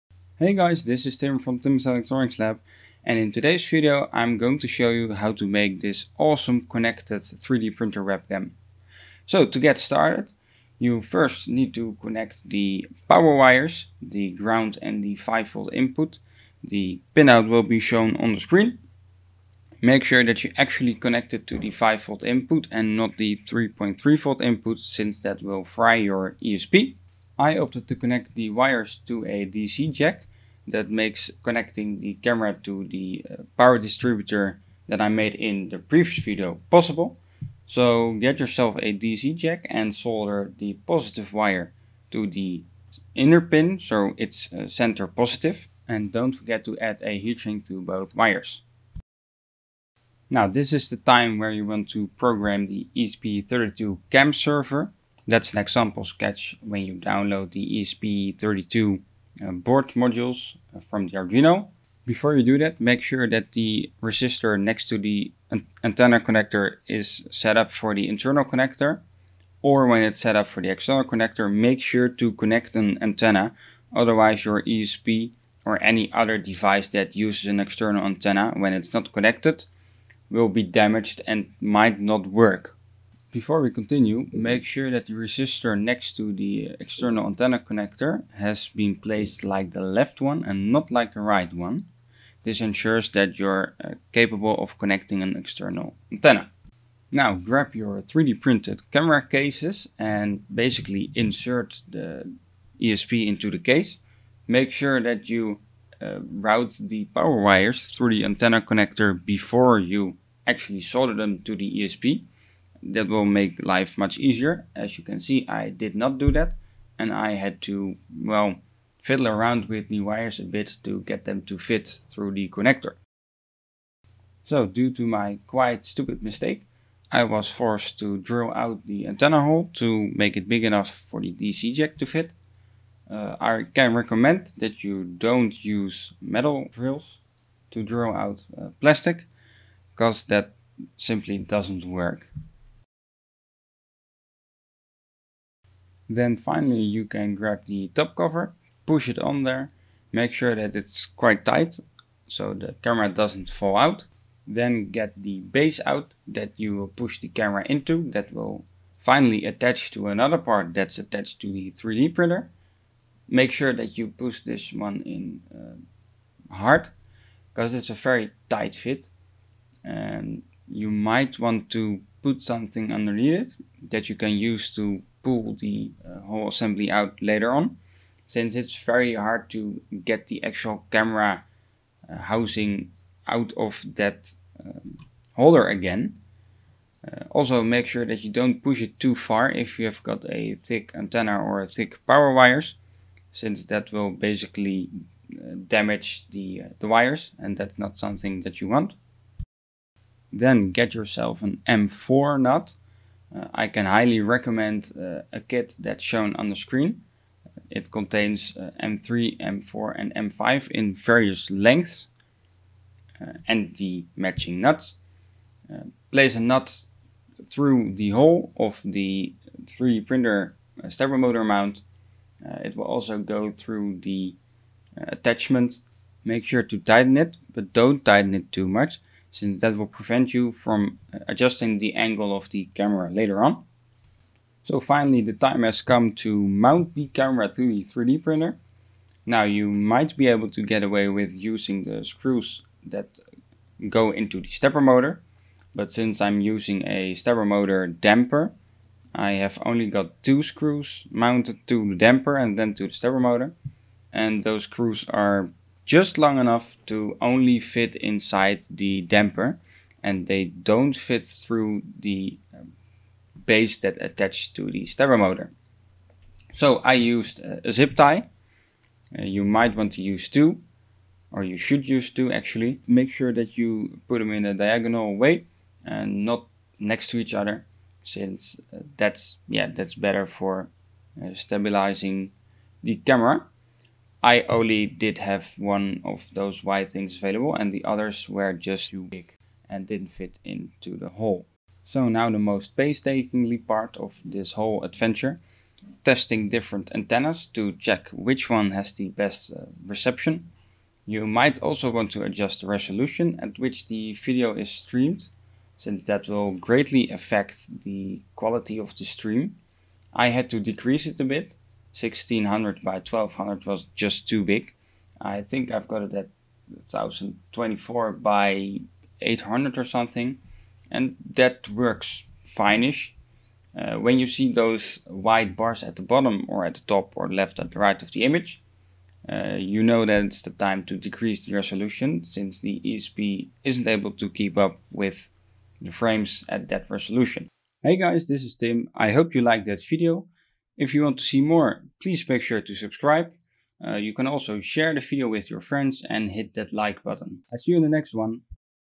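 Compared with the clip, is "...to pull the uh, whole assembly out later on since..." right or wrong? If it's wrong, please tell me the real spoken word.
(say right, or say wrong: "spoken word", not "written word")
right.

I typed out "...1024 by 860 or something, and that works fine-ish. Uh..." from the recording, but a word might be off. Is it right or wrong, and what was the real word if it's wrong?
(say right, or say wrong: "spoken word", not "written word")
wrong: "800", not "860".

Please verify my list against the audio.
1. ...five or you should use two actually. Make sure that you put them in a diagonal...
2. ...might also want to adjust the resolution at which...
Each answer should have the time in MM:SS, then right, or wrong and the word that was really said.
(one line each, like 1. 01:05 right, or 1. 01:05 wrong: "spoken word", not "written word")
1. 04:30 wrong: "two", not "five"
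2. 05:01 right.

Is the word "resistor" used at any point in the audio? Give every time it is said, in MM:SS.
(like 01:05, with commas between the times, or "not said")
01:04, 01:25.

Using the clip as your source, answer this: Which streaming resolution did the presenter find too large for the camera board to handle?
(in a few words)
1600 by 1200.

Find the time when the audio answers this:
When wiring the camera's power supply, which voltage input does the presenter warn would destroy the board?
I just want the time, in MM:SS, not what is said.
00:23.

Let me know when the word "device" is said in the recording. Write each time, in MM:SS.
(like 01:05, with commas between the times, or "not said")
01:16.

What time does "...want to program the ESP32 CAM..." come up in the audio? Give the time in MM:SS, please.
00:51.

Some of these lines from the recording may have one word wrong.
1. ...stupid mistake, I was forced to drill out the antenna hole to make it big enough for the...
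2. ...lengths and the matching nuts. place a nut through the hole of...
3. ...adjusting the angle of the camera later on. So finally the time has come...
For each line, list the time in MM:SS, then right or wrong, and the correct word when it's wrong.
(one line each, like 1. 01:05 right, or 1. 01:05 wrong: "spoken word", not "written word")
1. 02:05 right
2. 03:31 right
3. 03:51 right.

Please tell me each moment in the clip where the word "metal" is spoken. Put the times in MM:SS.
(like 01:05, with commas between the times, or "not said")
02:16.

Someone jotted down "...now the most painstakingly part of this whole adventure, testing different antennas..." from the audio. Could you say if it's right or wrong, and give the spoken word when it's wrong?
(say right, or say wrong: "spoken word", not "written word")
right.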